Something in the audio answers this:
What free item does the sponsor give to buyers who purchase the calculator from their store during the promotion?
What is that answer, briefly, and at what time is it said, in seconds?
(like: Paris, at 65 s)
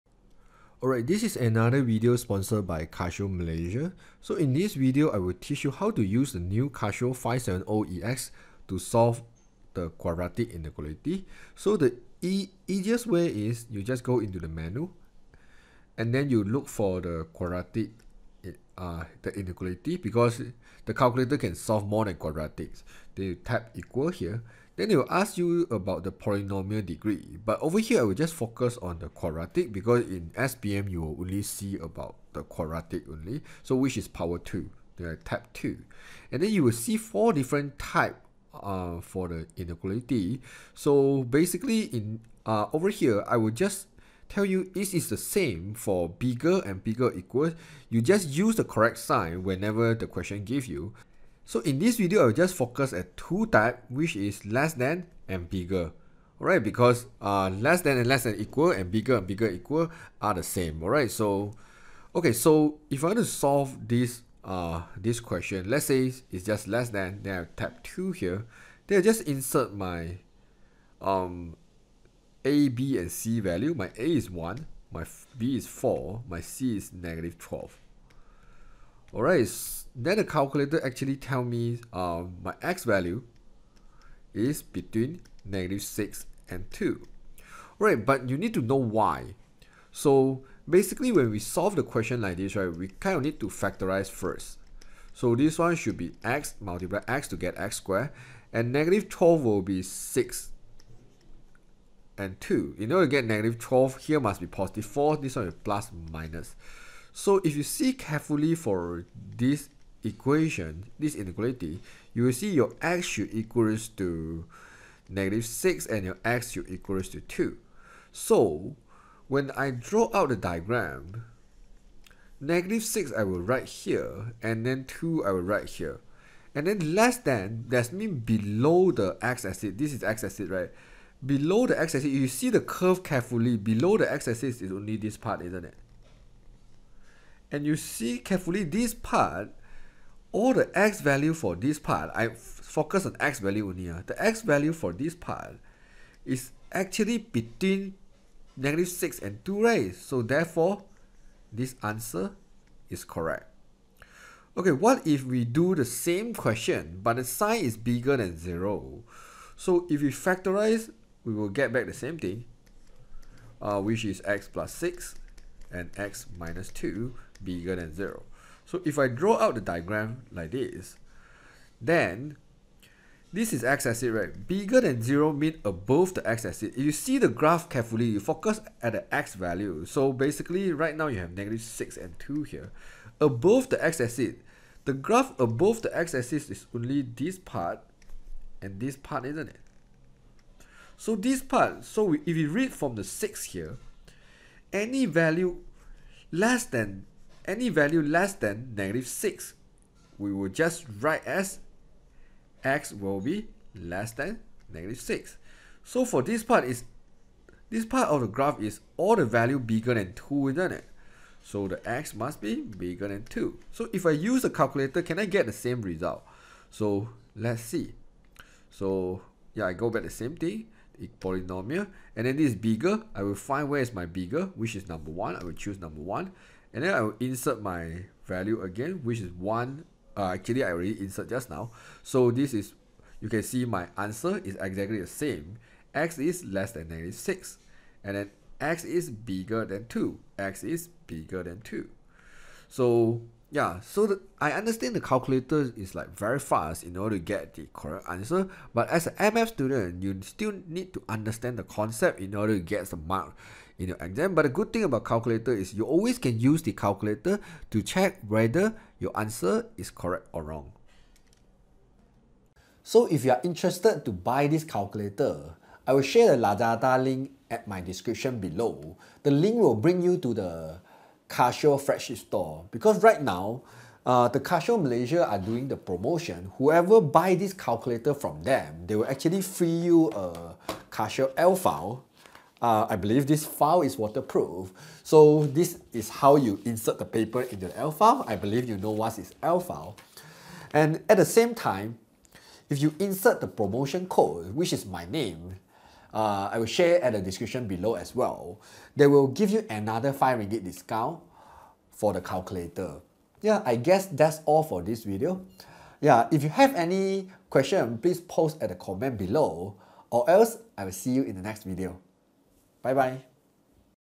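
Casio L file, at 280 s.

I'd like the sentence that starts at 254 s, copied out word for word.
But the good thing about calculator is you always can use the calculator to check whether your answer is correct or wrong.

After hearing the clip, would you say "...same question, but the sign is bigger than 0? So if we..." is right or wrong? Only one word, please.
right.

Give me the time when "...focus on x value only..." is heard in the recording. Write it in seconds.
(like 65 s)
142 s.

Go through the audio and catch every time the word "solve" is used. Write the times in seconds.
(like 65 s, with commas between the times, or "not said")
8 s, 21 s, 63 s, 91 s.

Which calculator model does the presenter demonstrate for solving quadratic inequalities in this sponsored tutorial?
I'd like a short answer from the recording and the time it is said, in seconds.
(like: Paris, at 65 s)
Casio 570EX, at 6 s.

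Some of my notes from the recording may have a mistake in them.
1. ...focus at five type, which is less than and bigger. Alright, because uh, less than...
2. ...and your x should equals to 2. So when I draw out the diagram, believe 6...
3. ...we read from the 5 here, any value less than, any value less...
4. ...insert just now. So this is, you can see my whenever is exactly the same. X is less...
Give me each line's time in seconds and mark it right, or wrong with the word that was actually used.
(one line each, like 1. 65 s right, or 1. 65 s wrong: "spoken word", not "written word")
1. 52 s wrong: "two", not "five"
2. 115 s wrong: "negative", not "believe"
3. 192 s wrong: "6", not "5"
4. 230 s wrong: "answer", not "whenever".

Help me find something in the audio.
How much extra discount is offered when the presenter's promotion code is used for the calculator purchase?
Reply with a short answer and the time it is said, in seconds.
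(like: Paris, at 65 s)
5 ringgit, at 300 s.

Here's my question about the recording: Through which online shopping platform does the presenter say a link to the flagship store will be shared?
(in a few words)
Lazada.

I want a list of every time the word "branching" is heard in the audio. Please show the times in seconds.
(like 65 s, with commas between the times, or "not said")
not said.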